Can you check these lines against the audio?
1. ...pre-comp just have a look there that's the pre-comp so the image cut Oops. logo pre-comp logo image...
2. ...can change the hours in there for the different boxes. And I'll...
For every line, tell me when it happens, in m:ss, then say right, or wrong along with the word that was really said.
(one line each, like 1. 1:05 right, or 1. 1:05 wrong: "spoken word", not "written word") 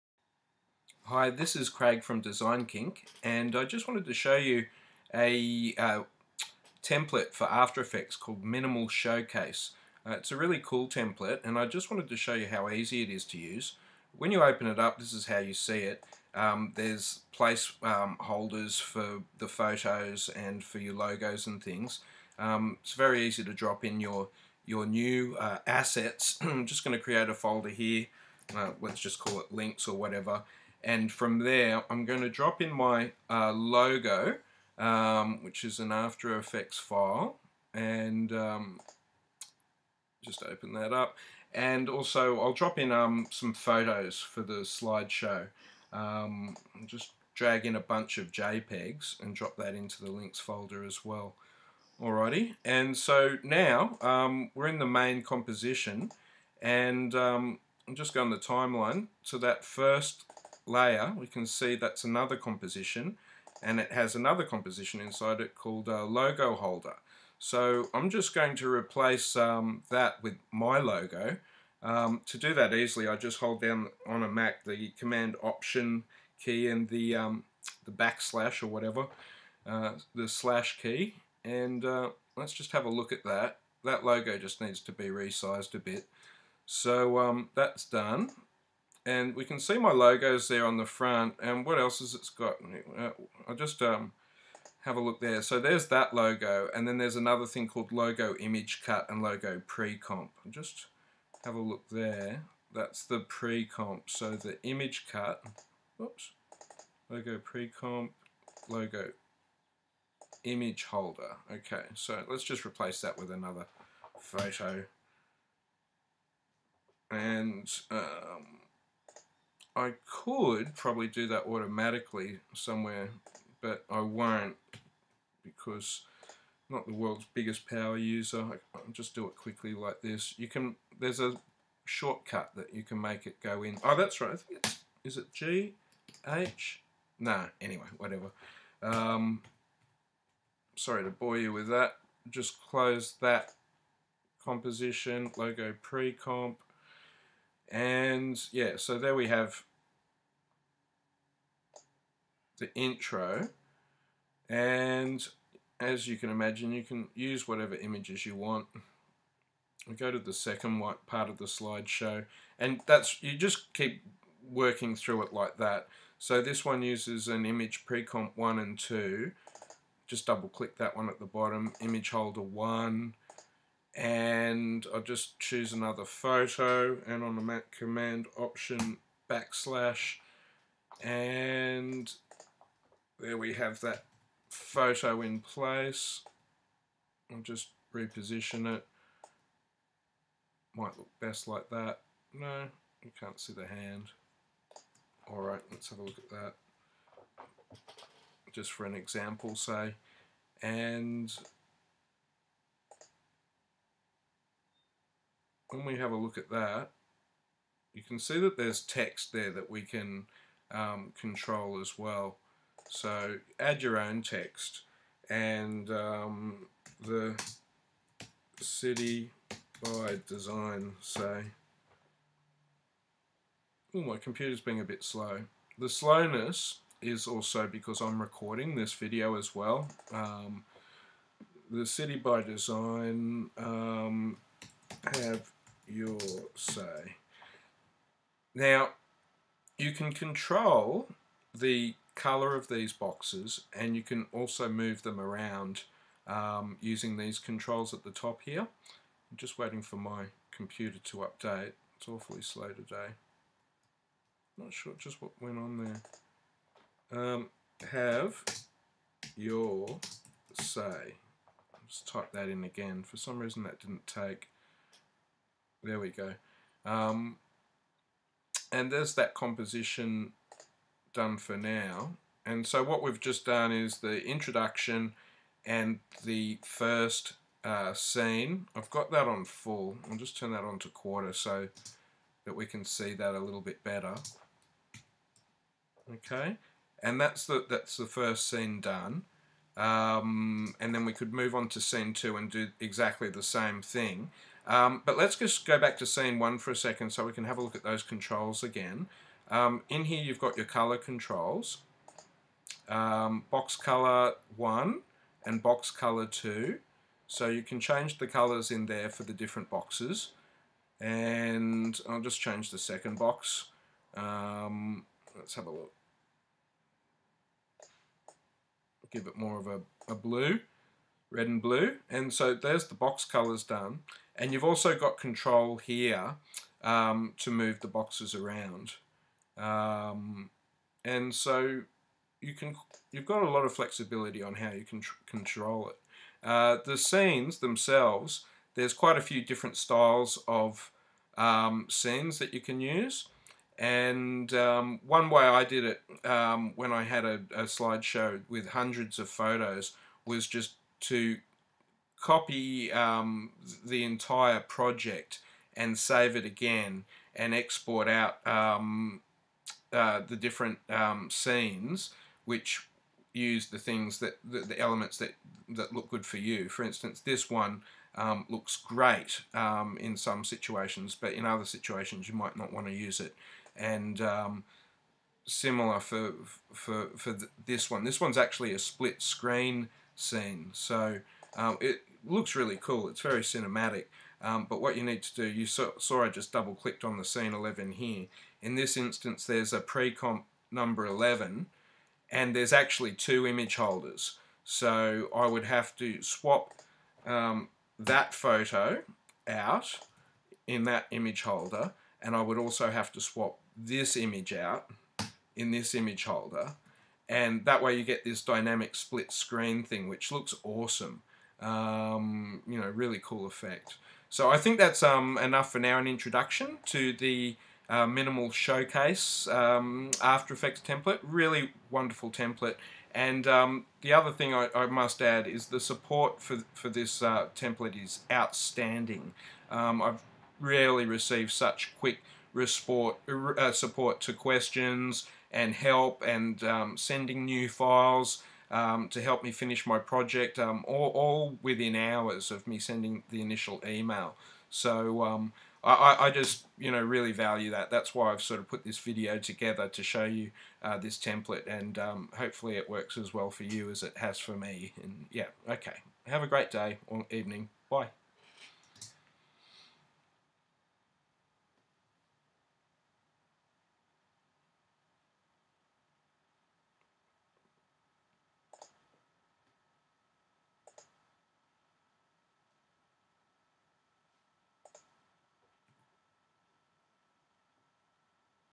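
1. 1:39 right
2. 5:07 wrong: "colors", not "hours".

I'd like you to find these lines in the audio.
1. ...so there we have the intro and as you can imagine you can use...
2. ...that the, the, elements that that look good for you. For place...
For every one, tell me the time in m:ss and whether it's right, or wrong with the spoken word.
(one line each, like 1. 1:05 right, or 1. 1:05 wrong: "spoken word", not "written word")
1. 2:28 right
2. 6:04 wrong: "instance", not "place".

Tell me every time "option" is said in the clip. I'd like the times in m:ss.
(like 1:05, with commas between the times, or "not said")
1:15, 2:58.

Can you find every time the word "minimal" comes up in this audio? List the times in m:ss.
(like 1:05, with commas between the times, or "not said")
0:08, 6:58.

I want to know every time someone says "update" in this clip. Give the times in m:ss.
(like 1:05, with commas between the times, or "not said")
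4:11.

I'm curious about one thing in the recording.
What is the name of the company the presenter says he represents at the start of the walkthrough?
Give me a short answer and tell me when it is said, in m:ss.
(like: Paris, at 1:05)
Design Kink, at 0:02.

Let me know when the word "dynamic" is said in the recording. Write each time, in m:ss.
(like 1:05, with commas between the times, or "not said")
6:48.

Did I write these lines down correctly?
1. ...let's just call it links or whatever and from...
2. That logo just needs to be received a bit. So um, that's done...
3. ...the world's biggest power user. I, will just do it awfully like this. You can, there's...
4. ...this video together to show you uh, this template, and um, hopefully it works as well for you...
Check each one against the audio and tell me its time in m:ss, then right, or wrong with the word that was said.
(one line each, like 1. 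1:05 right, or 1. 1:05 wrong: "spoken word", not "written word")
1. 0:28 right
2. 1:23 wrong: "resized", not "received"
3. 2:06 wrong: "quickly", not "awfully"
4. 7:28 right.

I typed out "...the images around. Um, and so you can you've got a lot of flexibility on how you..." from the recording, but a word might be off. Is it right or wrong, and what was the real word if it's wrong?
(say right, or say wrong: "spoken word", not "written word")
wrong: "boxes", not "images".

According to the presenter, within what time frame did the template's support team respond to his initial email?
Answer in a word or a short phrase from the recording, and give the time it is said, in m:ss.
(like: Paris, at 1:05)
within hours, at 7:21.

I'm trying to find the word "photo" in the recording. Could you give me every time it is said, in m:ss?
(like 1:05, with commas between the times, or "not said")
0:19, 0:43, 1:54, 2:56, 3:04, 5:49, 6:38.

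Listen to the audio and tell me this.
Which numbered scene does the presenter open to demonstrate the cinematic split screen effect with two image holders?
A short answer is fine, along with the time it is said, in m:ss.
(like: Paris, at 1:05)
11, at 6:27.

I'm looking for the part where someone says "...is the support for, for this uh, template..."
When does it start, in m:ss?
7:05.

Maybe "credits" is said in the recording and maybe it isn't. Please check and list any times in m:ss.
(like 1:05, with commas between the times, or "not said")
not said.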